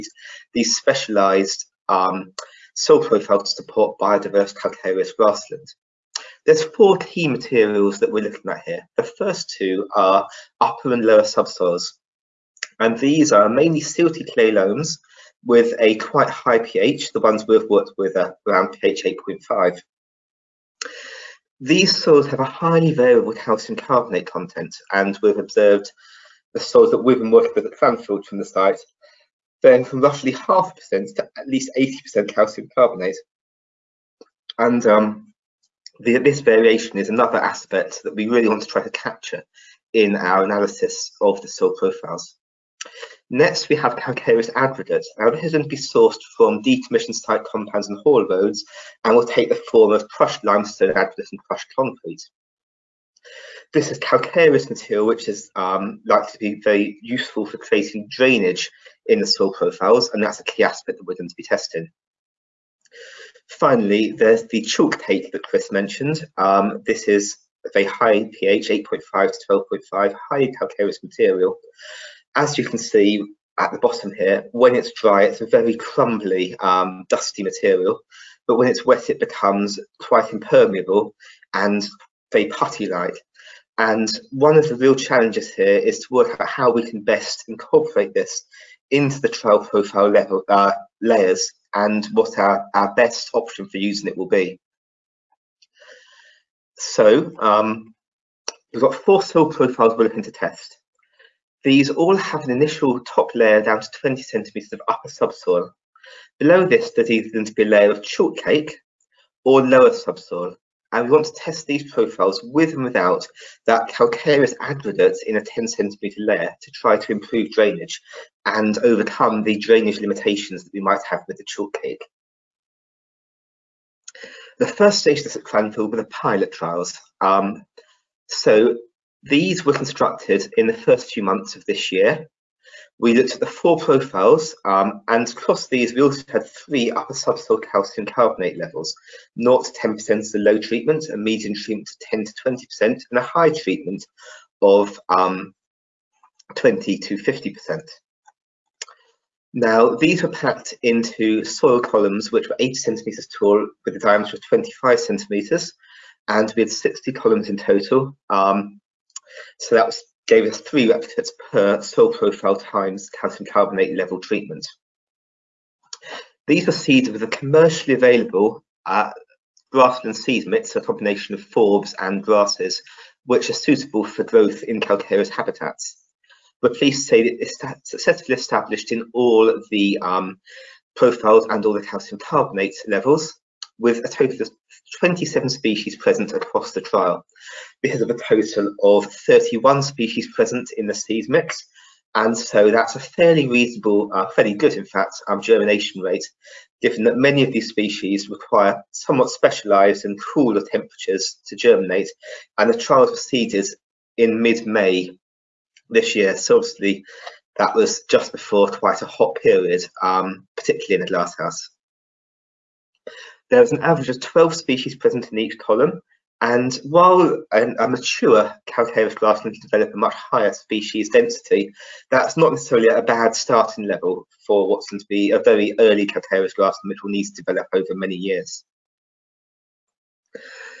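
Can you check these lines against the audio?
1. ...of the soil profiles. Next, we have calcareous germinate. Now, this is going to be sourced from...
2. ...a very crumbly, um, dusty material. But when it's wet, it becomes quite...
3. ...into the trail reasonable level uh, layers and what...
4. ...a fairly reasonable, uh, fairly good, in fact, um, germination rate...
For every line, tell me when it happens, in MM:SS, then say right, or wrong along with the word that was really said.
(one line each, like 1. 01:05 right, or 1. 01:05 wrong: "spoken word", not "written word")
1. 00:41 wrong: "aggregate", not "germinate"
2. 01:15 right
3. 01:28 wrong: "profile", not "reasonable"
4. 03:12 right.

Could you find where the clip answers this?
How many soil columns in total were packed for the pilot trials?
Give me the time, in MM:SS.
02:36.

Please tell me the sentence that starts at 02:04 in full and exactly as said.
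The first stage of this at Cranfield were the pilot trials.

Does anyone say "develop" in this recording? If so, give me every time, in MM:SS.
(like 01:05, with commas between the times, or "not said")
03:39, 03:47.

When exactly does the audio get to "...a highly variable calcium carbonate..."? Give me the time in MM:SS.
00:22.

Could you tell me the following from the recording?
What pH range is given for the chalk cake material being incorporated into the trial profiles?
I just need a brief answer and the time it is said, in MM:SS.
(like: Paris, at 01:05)
8.5 to 12.5, at 01:08.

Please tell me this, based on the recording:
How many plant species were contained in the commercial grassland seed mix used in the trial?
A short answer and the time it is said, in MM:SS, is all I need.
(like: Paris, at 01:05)
31, at 03:09.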